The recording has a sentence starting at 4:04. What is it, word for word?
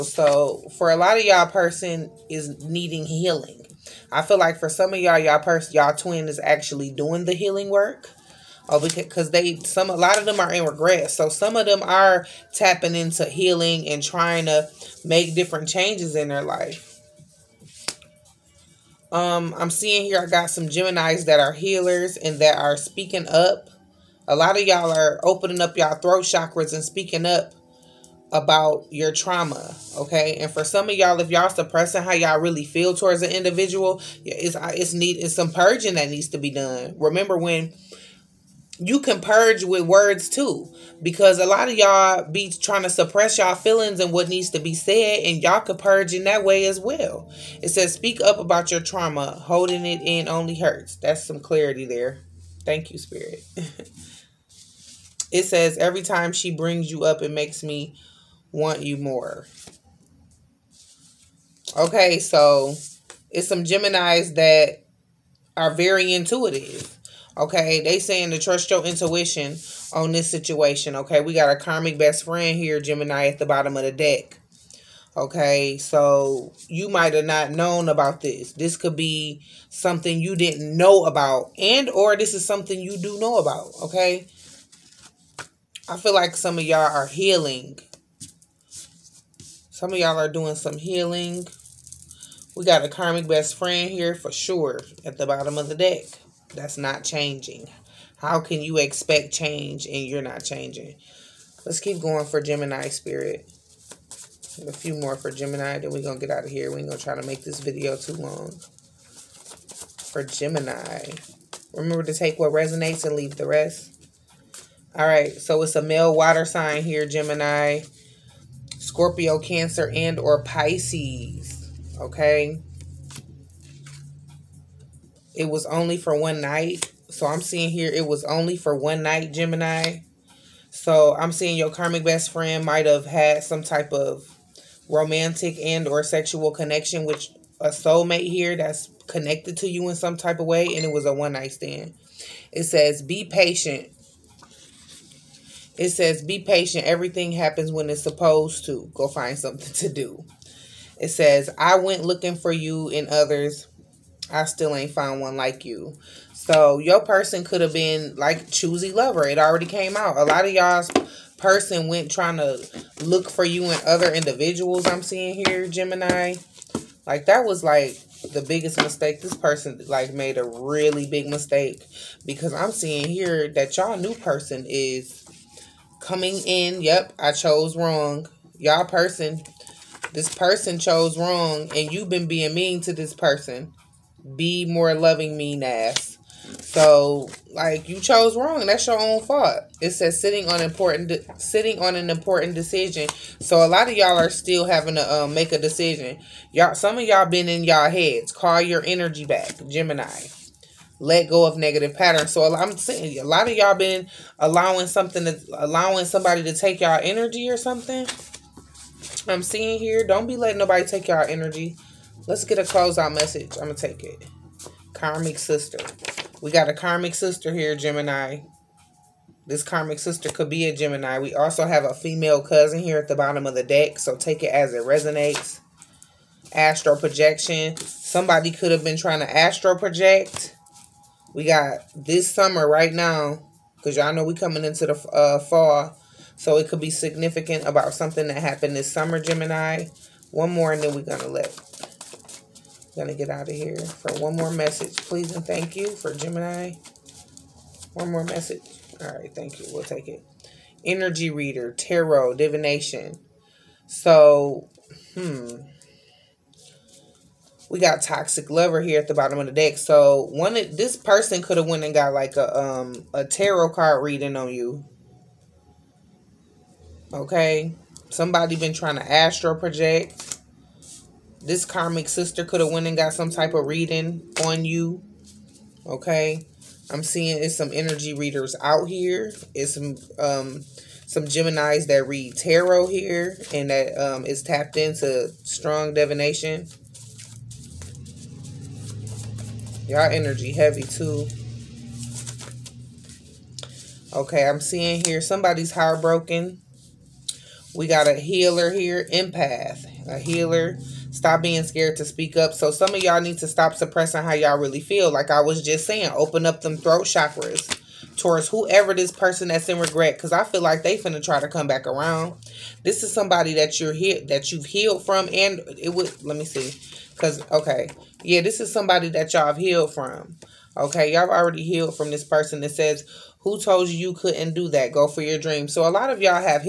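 Please and thank you for Gemini.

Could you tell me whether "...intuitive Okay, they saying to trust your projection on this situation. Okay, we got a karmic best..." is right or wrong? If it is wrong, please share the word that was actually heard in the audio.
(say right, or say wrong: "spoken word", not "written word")
wrong: "intuition", not "projection".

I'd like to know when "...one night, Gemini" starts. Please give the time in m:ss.
2:08.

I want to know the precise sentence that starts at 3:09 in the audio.
It says sitting on important sitting on an important decision.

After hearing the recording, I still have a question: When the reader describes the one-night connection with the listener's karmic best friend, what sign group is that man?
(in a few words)
water sign.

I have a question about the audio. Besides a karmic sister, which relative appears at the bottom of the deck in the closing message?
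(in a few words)
female cousin.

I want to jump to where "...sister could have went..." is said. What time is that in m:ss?
4:32.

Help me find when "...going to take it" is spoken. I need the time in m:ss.
3:33.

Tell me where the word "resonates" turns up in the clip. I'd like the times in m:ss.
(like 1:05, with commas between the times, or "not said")
1:52, 3:44.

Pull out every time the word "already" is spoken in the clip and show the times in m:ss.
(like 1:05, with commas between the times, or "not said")
2:39, 5:21.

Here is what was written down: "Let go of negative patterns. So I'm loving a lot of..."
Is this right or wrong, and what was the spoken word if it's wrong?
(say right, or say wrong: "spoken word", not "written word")
wrong: "saying", not "loving".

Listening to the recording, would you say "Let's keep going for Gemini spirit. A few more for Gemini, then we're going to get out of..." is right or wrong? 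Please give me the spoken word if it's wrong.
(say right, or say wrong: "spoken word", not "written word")
right.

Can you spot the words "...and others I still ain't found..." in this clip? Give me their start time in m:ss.
2:32.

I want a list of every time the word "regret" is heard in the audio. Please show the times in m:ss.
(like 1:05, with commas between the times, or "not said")
0:10, 5:09.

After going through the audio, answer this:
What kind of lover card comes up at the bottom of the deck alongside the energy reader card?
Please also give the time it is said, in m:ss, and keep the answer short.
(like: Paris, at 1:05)
toxic lover, at 4:18.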